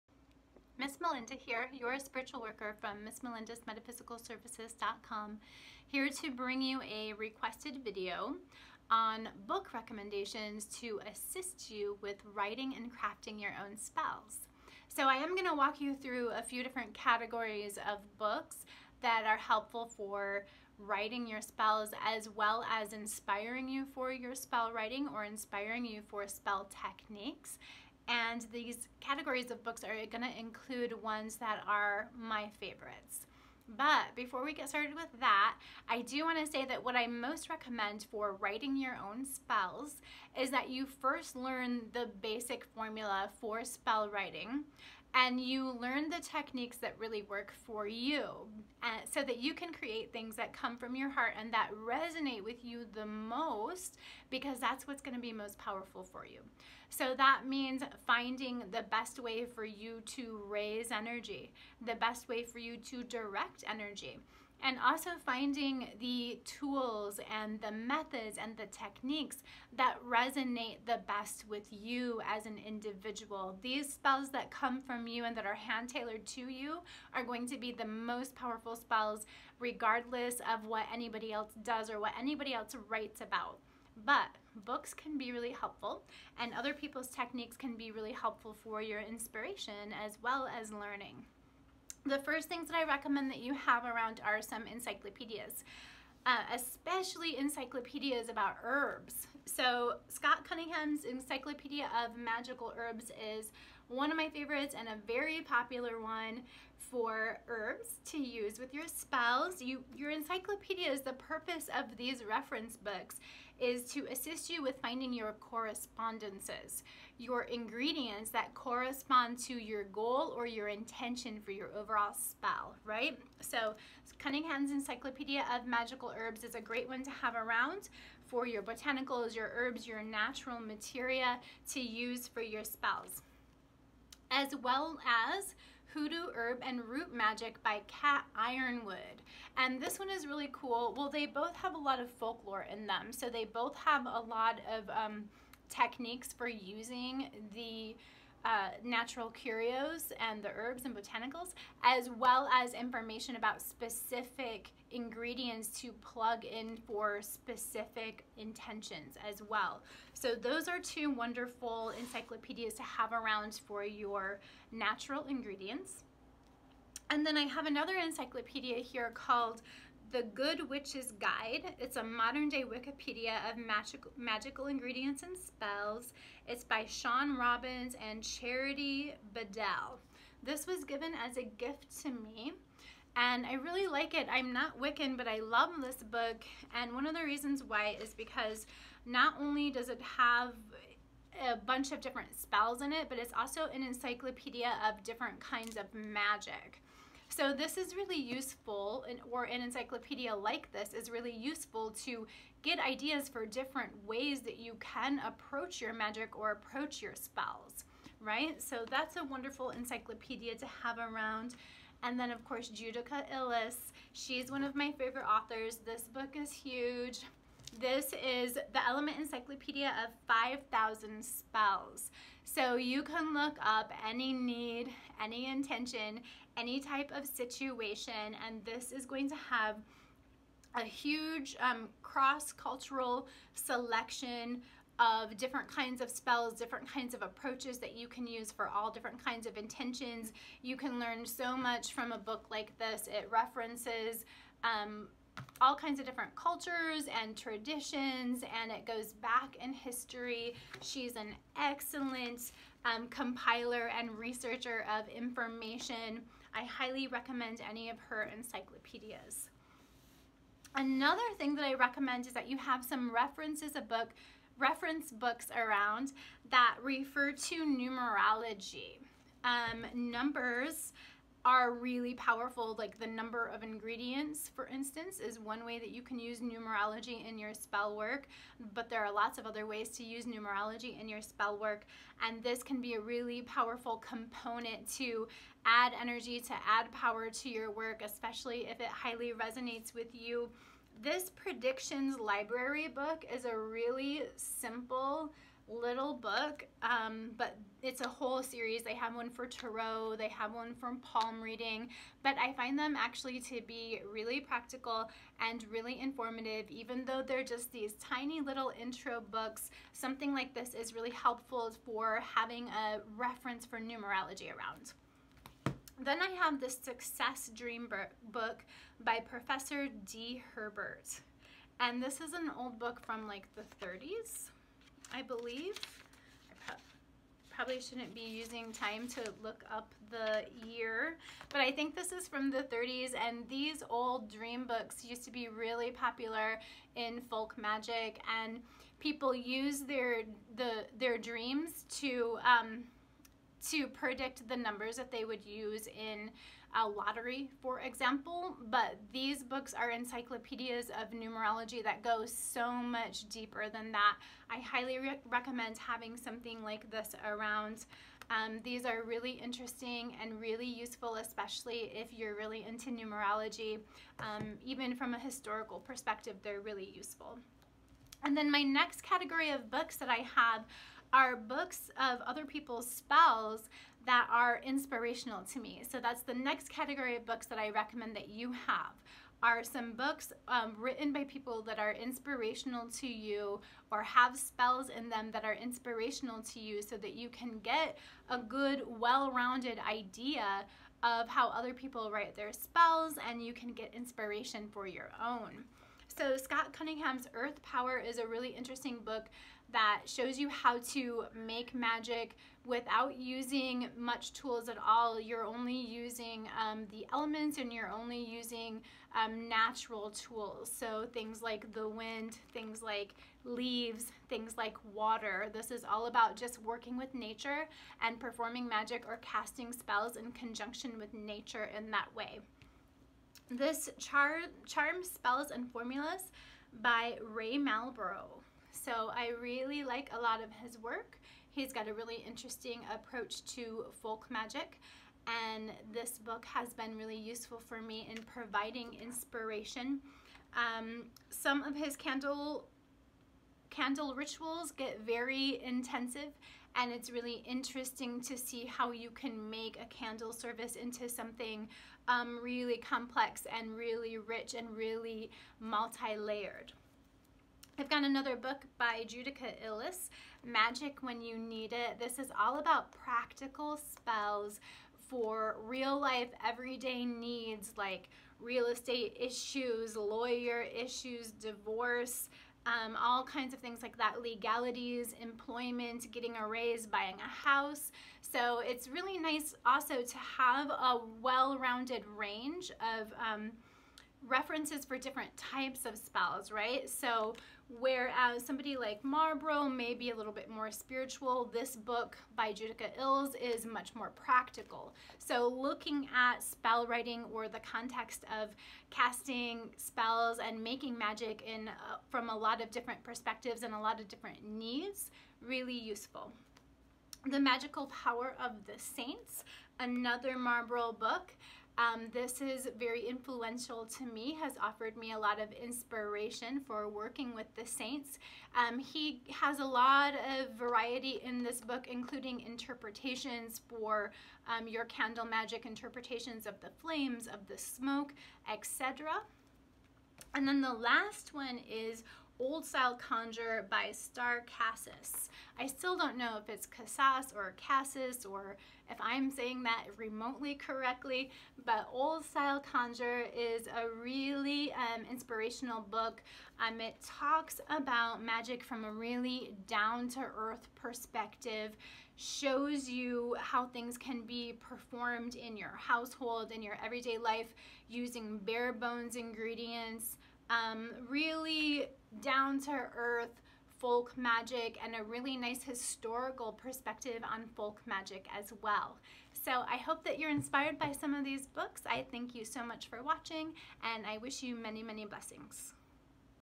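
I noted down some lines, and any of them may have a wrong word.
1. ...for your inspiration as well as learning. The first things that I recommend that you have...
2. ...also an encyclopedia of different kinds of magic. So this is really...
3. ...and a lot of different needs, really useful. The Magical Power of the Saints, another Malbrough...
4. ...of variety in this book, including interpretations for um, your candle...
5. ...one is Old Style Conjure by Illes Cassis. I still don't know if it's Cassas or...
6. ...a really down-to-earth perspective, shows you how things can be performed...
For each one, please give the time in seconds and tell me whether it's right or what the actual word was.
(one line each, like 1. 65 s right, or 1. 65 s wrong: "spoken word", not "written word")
1. 88 s right
2. 193 s right
3. 503 s right
4. 520 s right
5. 531 s wrong: "Starr", not "Illes"
6. 548 s right.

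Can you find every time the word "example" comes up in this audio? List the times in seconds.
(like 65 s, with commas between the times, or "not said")
347 s.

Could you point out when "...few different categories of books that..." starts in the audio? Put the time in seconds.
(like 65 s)
16 s.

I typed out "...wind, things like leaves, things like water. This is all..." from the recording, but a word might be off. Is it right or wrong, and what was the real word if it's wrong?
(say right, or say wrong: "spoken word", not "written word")
right.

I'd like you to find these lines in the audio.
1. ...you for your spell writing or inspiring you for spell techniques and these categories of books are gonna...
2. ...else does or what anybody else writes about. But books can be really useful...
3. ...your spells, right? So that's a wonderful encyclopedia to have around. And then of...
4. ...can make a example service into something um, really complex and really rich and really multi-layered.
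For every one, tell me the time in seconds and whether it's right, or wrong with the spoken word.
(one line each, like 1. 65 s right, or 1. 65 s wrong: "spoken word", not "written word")
1. 23 s right
2. 81 s wrong: "helpful", not "useful"
3. 207 s right
4. 449 s wrong: "candle", not "example".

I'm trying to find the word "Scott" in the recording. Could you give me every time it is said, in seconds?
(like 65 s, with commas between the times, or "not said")
100 s, 396 s.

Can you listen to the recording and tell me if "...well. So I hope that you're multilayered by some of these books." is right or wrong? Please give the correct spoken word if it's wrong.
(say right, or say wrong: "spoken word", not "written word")
wrong: "inspired", not "multilayered".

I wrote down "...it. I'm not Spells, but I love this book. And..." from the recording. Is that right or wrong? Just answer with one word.
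wrong.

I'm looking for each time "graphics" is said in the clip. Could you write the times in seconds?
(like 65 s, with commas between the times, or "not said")
not said.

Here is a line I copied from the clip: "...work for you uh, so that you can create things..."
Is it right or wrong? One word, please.
right.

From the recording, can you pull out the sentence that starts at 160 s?
So those are two wonderful encyclopedias to have around for your natural ingredients.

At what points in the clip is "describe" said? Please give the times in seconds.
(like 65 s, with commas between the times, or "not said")
not said.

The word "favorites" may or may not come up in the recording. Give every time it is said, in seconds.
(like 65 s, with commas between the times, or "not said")
32 s, 104 s, 214 s.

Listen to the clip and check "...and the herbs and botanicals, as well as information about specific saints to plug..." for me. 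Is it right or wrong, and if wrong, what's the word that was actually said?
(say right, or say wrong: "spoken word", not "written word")
wrong: "ingredients", not "saints".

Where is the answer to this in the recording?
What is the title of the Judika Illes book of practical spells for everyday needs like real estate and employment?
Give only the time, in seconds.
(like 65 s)
460 s.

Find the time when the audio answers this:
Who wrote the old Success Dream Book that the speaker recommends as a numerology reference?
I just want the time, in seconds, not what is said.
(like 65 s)
319 s.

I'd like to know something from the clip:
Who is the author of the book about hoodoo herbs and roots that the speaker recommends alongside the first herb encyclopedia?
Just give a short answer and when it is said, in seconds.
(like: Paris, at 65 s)
Cat Yronwode, at 137 s.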